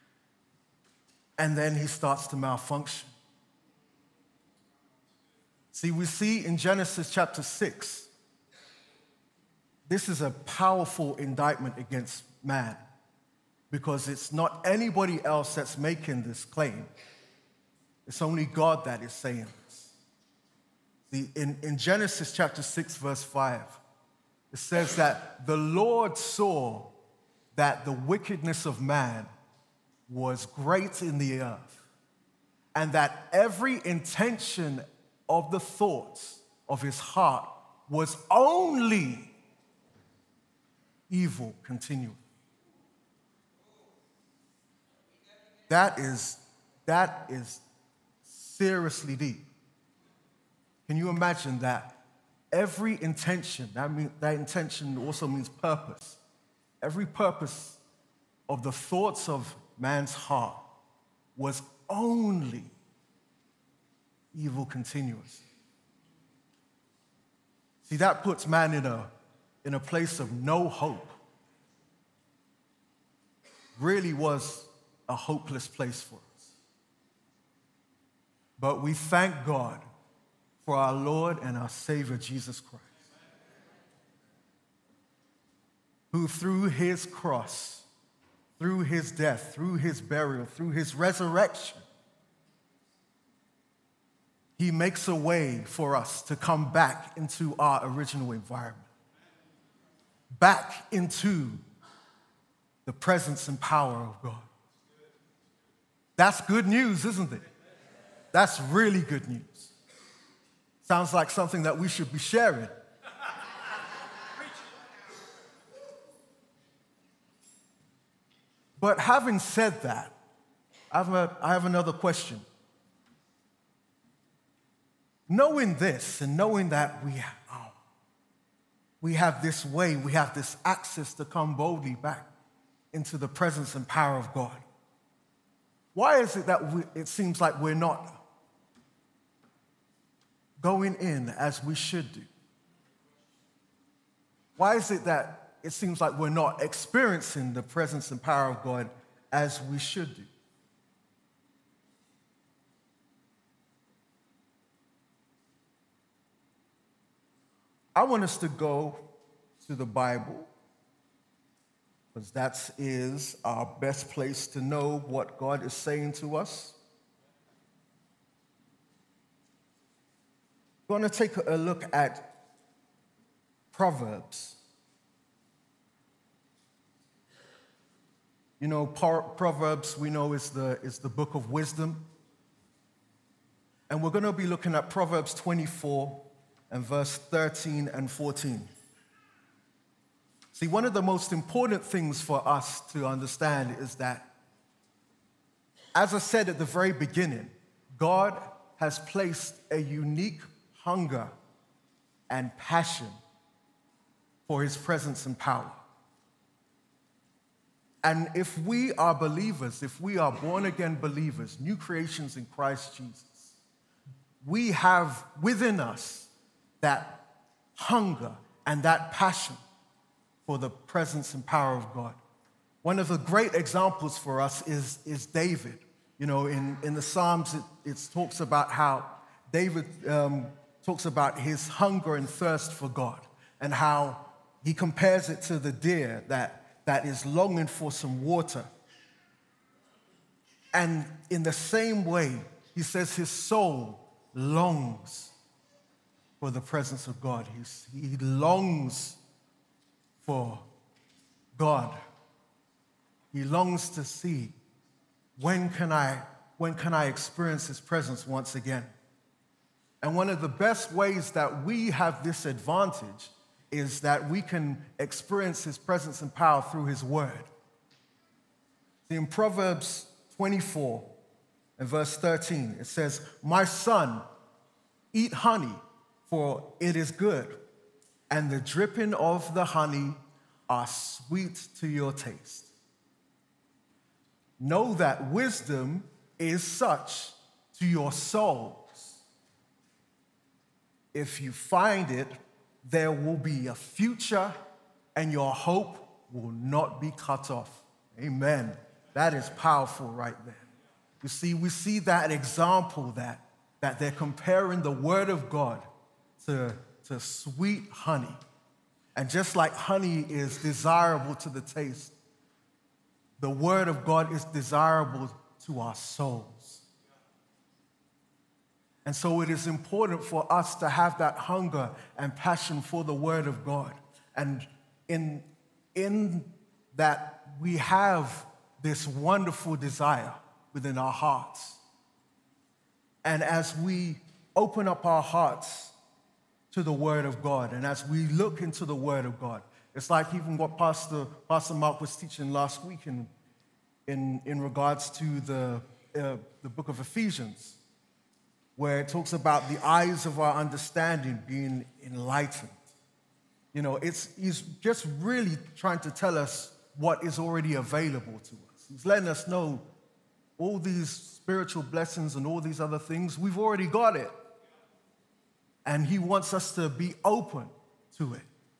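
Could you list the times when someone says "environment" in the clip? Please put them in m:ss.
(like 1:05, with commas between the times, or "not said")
1:38.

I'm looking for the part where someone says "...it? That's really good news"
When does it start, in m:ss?
1:47.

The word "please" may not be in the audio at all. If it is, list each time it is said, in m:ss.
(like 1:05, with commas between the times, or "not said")
not said.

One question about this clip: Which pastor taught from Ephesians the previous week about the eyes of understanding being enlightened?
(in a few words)
Pastor Mark.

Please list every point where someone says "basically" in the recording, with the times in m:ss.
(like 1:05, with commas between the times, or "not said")
not said.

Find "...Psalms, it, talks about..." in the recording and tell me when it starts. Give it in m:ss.
3:47.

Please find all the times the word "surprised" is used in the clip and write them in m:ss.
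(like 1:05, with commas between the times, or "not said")
not said.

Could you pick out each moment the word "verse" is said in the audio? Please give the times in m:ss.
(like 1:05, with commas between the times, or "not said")
0:22, 3:06, 4:31.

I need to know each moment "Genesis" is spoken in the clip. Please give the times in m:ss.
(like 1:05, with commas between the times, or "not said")
0:06, 0:21.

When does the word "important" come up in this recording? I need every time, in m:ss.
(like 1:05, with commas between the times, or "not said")
3:11, 5:19.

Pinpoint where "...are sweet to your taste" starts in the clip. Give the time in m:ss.
4:40.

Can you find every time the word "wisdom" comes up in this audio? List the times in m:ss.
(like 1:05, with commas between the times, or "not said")
3:01, 4:45.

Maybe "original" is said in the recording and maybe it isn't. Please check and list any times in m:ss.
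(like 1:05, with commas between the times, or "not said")
1:37.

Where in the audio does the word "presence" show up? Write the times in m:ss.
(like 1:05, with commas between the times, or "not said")
1:42, 2:13, 2:27, 3:24, 3:40, 4:06, 4:17, 4:25.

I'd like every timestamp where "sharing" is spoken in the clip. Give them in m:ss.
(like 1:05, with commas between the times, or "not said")
1:52.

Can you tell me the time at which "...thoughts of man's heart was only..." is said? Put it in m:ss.
0:58.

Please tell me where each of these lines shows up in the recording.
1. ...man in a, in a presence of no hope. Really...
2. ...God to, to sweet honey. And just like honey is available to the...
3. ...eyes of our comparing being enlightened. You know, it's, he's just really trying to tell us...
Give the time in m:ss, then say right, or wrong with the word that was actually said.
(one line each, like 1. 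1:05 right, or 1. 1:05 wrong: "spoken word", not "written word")
1. 1:08 wrong: "place", not "presence"
2. 5:05 wrong: "desirable", not "available"
3. 5:49 wrong: "understanding", not "comparing".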